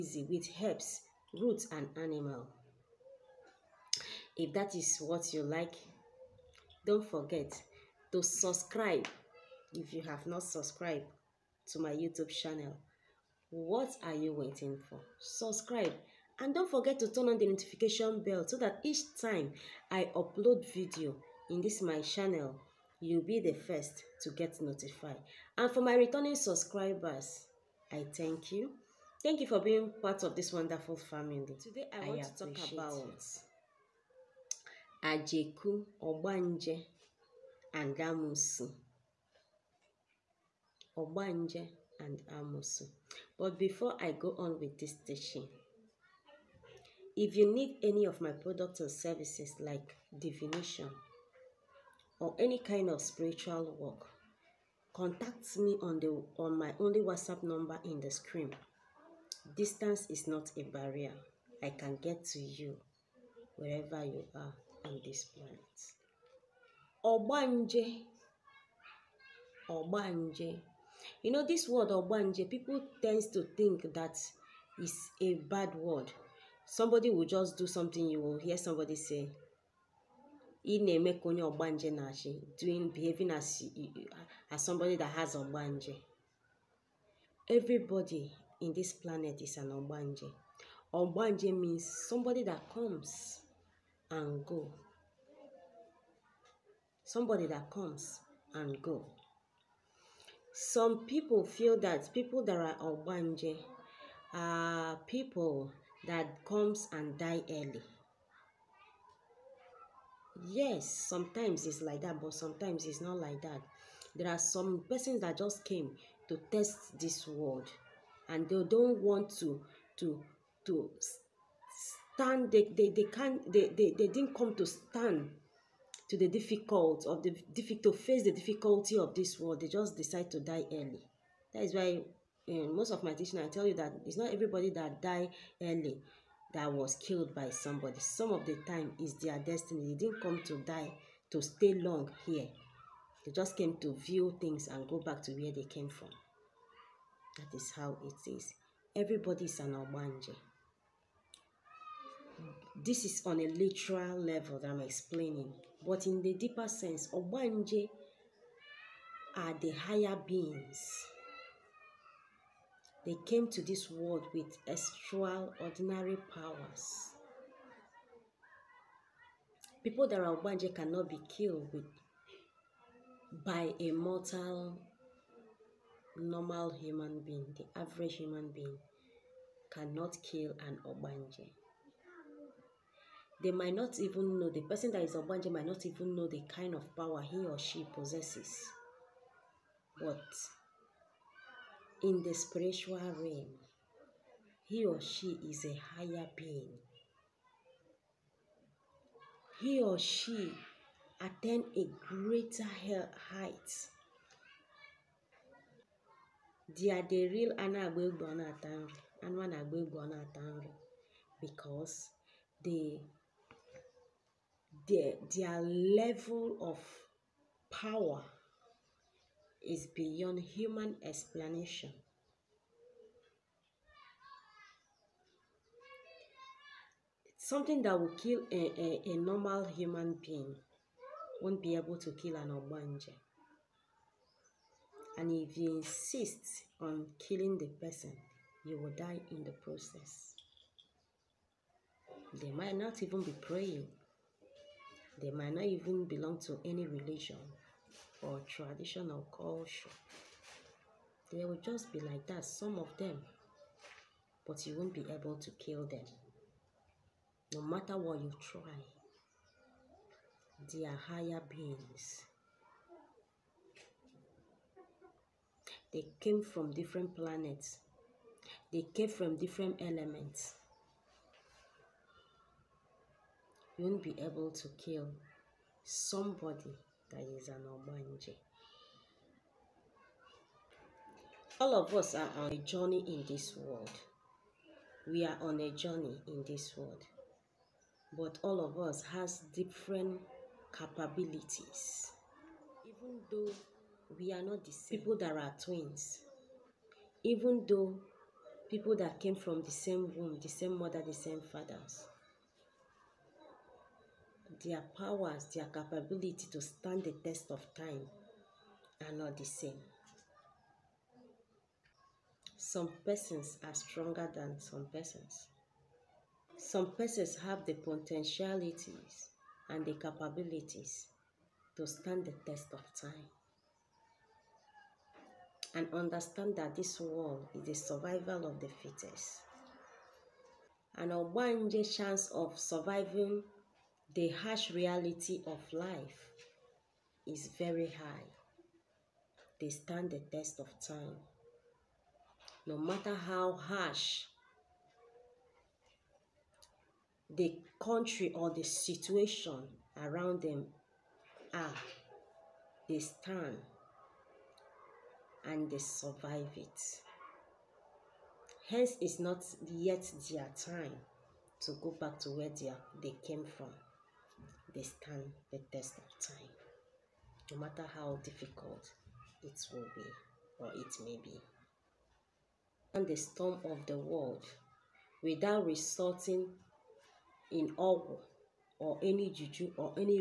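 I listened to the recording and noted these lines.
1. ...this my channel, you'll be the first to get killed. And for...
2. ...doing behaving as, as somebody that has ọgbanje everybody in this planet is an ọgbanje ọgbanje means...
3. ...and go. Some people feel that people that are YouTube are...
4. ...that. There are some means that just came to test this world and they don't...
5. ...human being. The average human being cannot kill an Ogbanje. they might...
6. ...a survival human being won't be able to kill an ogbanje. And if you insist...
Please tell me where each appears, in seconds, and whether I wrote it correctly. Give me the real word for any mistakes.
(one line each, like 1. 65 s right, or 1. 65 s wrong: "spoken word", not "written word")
1. 21 s wrong: "notified", not "killed"
2. 82 s right
3. 98 s wrong: "Ogbanje", not "YouTube"
4. 113 s wrong: "persons", not "means"
5. 176 s right
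6. 229 s wrong: "normal", not "survival".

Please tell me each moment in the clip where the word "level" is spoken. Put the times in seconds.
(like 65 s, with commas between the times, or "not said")
154 s, 215 s.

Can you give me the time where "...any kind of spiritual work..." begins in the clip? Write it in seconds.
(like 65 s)
52 s.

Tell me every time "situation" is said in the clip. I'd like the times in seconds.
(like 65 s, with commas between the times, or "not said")
348 s.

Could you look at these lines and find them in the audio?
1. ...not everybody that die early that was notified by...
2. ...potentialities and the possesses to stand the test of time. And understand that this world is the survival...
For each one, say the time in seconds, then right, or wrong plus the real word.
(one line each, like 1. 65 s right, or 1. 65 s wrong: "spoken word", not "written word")
1. 134 s wrong: "killed", not "notified"
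2. 317 s wrong: "capabilities", not "possesses".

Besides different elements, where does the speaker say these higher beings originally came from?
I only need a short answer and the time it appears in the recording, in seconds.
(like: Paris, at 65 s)
different planets, at 266 s.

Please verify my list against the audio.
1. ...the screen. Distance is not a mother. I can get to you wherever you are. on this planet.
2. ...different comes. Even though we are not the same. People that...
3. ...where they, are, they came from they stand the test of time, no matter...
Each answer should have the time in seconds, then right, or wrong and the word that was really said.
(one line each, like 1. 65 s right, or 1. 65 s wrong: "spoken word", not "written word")
1. 57 s wrong: "barrier", not "mother"
2. 289 s wrong: "capabilities", not "comes"
3. 362 s right.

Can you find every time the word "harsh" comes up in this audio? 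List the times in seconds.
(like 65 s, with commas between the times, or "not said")
334 s, 343 s.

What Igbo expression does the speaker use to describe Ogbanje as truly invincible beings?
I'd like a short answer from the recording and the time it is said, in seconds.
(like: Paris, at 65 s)
anụ agba egbe, at 207 s.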